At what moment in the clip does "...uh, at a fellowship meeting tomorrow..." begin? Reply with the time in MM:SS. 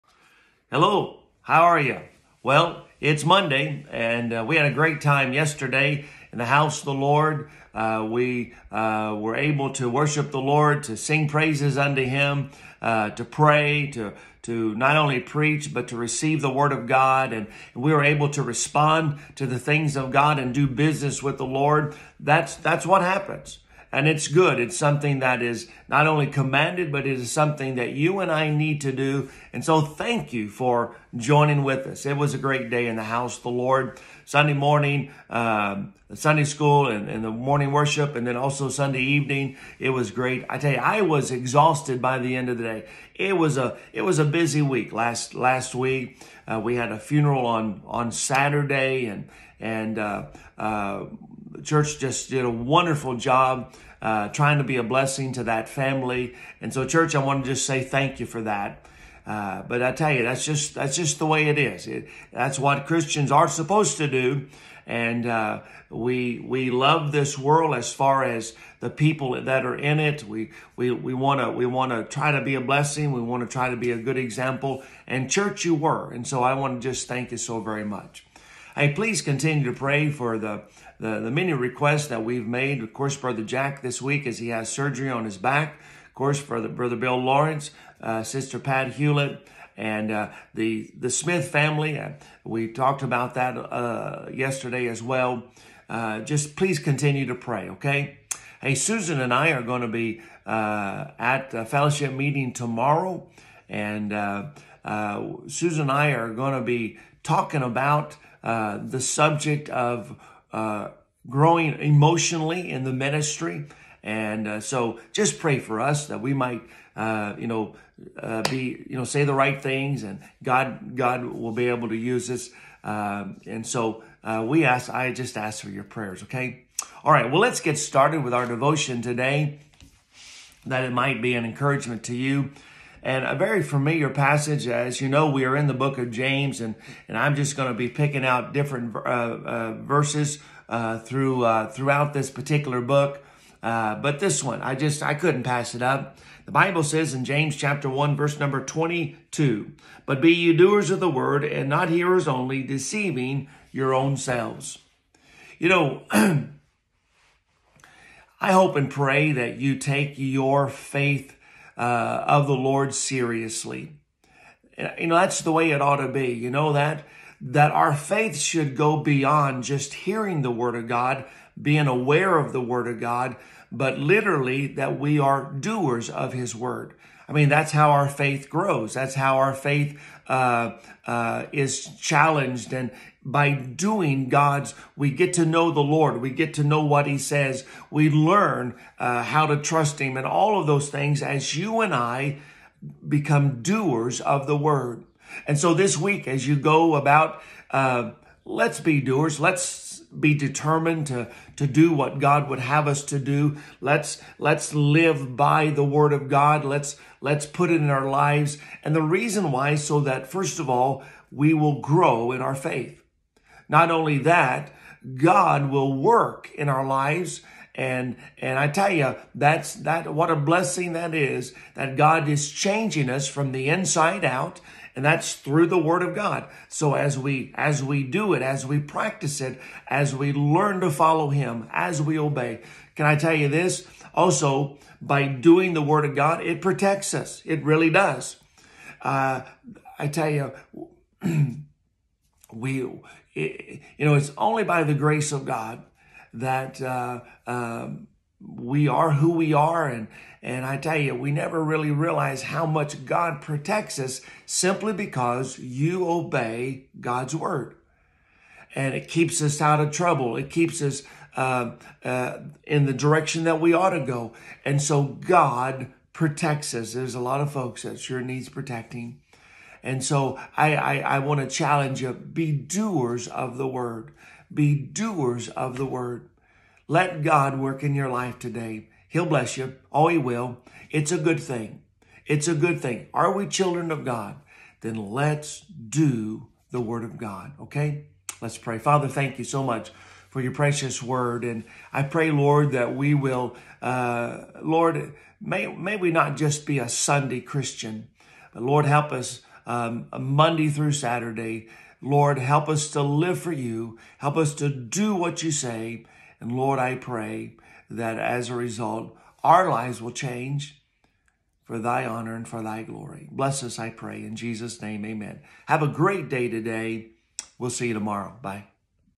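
01:40.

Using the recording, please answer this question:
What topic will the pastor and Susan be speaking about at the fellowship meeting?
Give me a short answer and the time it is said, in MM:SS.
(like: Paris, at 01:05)
Growing emotionally in the ministry, at 01:51.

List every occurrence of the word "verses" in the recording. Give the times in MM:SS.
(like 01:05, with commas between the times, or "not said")
02:19, 02:28.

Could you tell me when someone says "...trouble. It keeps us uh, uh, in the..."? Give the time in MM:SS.
04:19.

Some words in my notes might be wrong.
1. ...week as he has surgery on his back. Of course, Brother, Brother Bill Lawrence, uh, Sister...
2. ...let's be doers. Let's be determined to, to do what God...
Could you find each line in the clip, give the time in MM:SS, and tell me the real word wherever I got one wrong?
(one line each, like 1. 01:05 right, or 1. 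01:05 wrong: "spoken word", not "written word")
1. 01:24 right
2. 03:18 right.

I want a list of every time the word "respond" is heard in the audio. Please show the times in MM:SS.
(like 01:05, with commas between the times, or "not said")
00:18.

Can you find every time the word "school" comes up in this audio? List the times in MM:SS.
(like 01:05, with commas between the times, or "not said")
00:36.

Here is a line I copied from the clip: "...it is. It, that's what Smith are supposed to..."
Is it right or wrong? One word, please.
wrong.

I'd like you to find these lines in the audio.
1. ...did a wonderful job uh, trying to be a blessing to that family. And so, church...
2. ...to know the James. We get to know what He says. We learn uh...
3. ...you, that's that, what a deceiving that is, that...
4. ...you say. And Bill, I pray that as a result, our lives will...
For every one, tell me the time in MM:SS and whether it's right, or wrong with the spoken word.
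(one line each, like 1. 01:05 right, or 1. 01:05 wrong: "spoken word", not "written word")
1. 00:52 right
2. 03:05 wrong: "Lord", not "James"
3. 03:38 wrong: "blessing", not "deceiving"
4. 05:05 wrong: "Lord", not "Bill".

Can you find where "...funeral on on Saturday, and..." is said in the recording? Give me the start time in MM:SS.
00:46.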